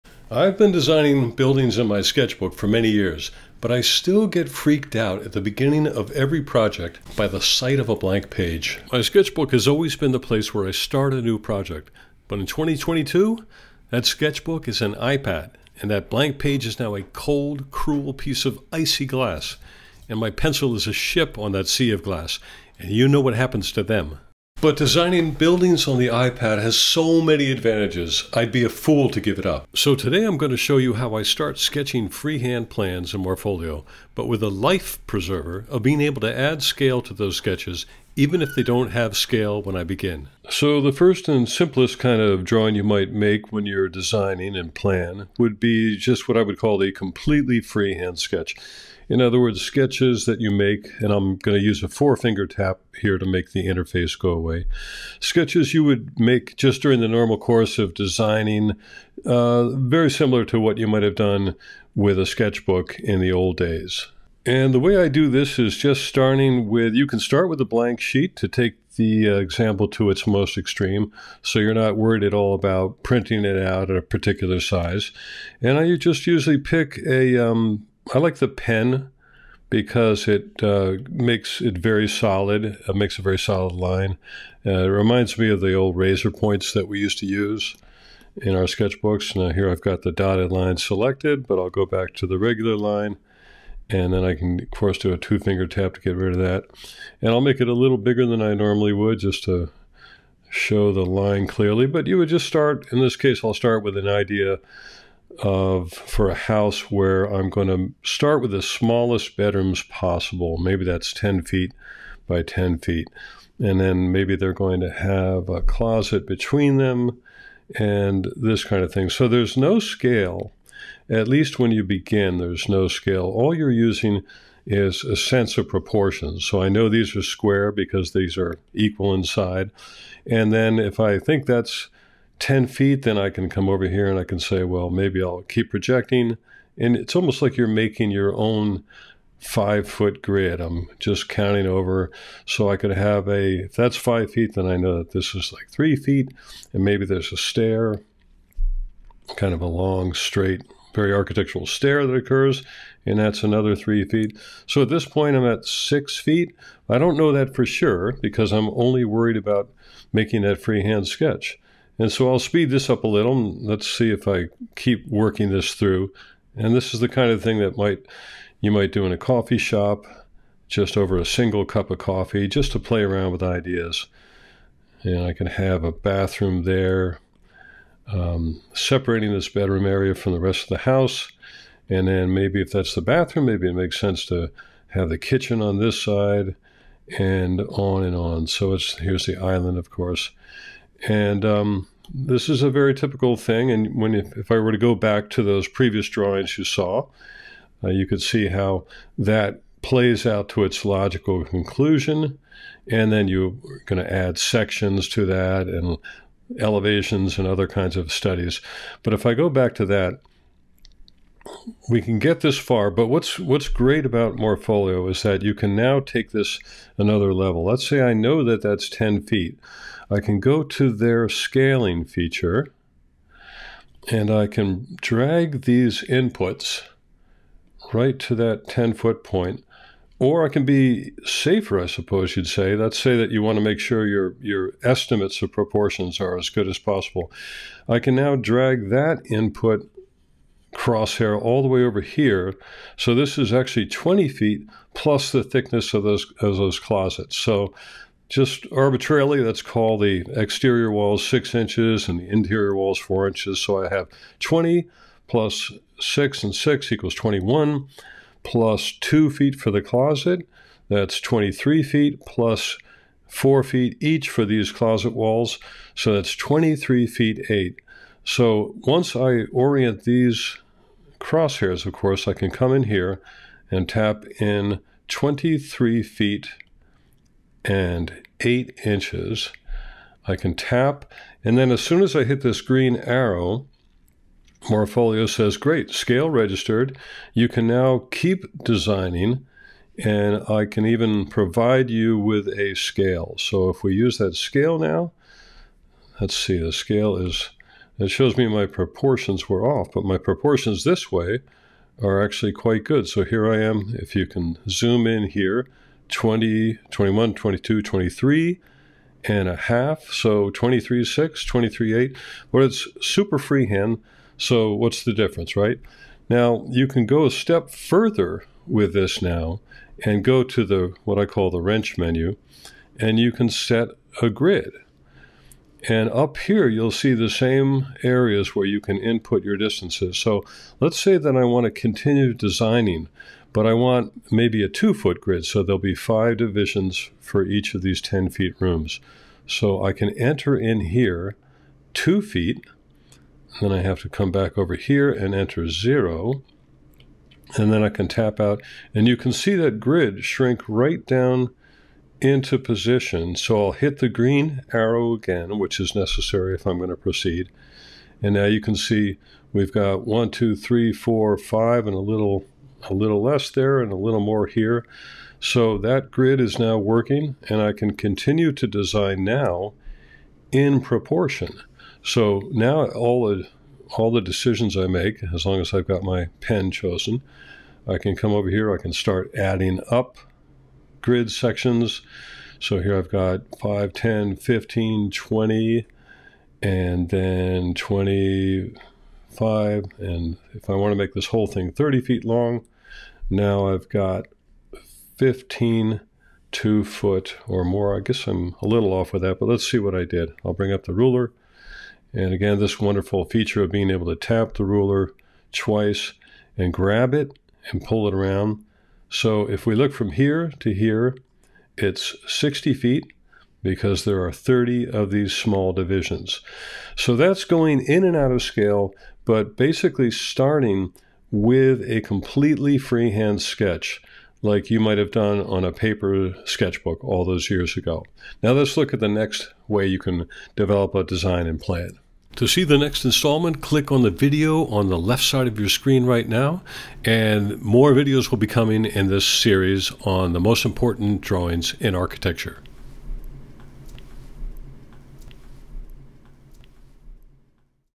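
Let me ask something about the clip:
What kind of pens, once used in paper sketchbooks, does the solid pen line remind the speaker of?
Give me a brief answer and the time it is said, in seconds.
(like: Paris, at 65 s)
razor points, at 85 s.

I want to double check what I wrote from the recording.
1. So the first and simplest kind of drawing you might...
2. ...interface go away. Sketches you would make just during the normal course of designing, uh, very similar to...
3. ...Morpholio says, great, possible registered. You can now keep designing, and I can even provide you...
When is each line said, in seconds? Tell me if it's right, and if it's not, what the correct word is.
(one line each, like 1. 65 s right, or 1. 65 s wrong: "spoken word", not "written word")
1. 40 s right
2. 53 s right
3. 284 s wrong: "scale", not "possible".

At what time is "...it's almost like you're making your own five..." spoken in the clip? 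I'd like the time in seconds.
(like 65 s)
136 s.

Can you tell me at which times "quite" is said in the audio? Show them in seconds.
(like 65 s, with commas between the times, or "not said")
302 s.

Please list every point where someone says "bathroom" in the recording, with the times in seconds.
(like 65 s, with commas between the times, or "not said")
175 s, 183 s.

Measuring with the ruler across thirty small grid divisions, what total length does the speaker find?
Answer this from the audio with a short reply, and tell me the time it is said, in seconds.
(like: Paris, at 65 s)
60 feet, at 412 s.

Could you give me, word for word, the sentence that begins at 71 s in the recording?
So you're not worried at all about printing it out at a particular size.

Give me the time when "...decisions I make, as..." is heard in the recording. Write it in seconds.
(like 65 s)
374 s.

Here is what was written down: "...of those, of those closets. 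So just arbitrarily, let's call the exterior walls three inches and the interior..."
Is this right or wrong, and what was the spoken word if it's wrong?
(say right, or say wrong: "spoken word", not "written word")
wrong: "six", not "three".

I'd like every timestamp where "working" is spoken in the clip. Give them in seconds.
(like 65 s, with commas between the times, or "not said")
165 s, 366 s.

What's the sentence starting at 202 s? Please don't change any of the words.
And then you're going to add sections to that and elevations and other kinds of studies.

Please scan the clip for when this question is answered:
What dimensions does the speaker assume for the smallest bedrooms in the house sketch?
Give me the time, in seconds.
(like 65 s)
111 s.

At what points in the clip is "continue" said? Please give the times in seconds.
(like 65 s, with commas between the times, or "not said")
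331 s, 367 s.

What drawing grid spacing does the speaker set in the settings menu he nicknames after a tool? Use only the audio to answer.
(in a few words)
2 feet.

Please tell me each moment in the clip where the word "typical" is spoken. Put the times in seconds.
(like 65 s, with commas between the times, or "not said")
192 s.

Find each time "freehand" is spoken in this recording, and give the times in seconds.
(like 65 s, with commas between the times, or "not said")
32 s, 47 s, 160 s, 313 s, 422 s.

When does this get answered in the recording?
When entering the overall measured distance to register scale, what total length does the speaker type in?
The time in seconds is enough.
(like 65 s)
275 s.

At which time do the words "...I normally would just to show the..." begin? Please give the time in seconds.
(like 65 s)
98 s.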